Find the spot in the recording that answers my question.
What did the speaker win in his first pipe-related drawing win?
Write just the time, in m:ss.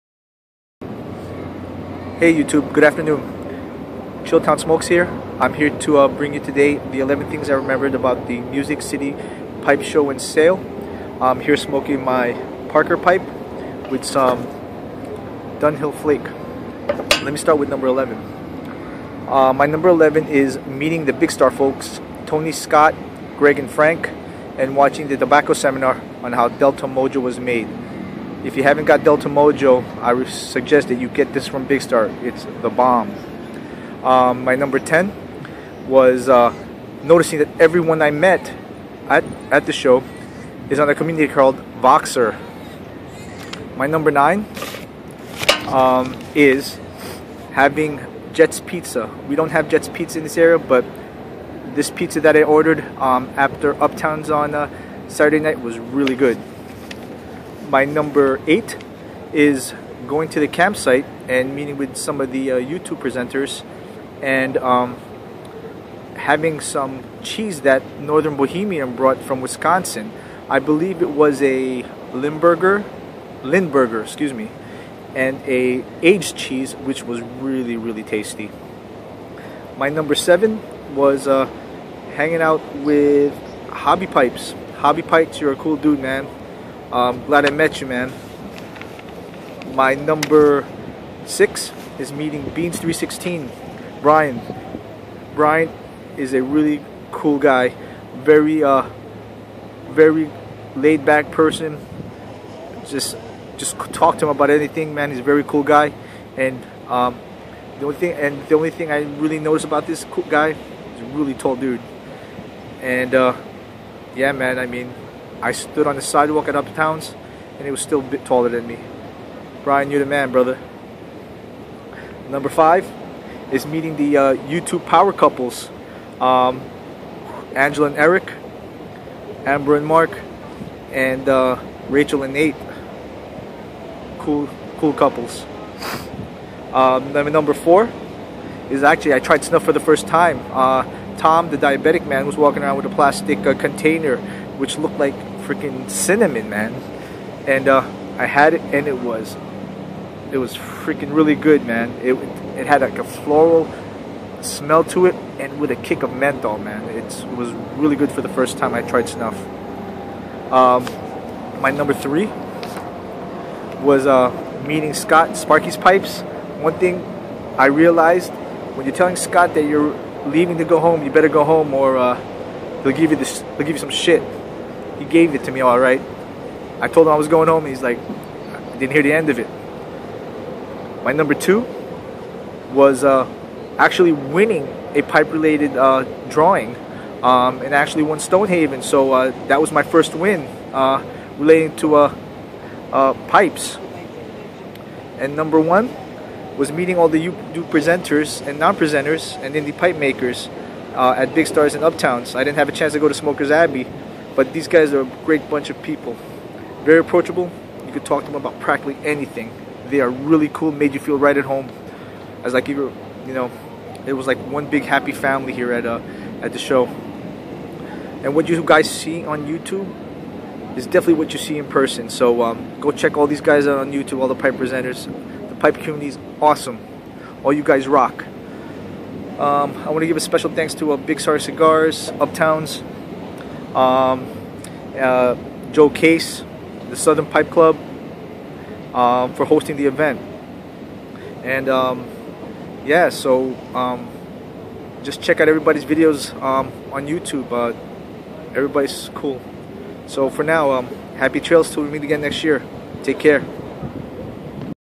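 3:08.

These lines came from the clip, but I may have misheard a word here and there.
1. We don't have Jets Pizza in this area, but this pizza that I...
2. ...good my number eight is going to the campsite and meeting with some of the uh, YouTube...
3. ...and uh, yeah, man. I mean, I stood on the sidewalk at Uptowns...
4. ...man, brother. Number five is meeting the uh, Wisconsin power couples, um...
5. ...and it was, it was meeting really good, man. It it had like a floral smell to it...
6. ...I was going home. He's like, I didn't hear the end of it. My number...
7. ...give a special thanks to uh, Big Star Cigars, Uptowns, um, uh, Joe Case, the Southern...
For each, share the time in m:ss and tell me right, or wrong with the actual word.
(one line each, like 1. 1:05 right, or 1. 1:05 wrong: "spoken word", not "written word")
1. 0:49 right
2. 0:56 right
3. 1:52 right
4. 2:00 wrong: "YouTube", not "Wisconsin"
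5. 2:28 wrong: "freaking", not "meeting"
6. 2:57 right
7. 3:50 right.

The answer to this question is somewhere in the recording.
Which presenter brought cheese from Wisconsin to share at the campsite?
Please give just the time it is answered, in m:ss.
1:07.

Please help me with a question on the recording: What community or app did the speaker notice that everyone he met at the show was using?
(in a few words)
Voxer.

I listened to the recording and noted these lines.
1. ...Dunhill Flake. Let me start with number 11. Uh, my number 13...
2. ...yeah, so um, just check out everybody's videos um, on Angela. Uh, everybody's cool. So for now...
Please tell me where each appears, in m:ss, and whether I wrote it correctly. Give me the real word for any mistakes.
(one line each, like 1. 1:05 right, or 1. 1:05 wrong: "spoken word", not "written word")
1. 0:15 wrong: "11", not "13"
2. 4:02 wrong: "YouTube", not "Angela".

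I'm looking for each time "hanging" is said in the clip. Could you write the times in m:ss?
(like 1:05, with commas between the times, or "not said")
1:22.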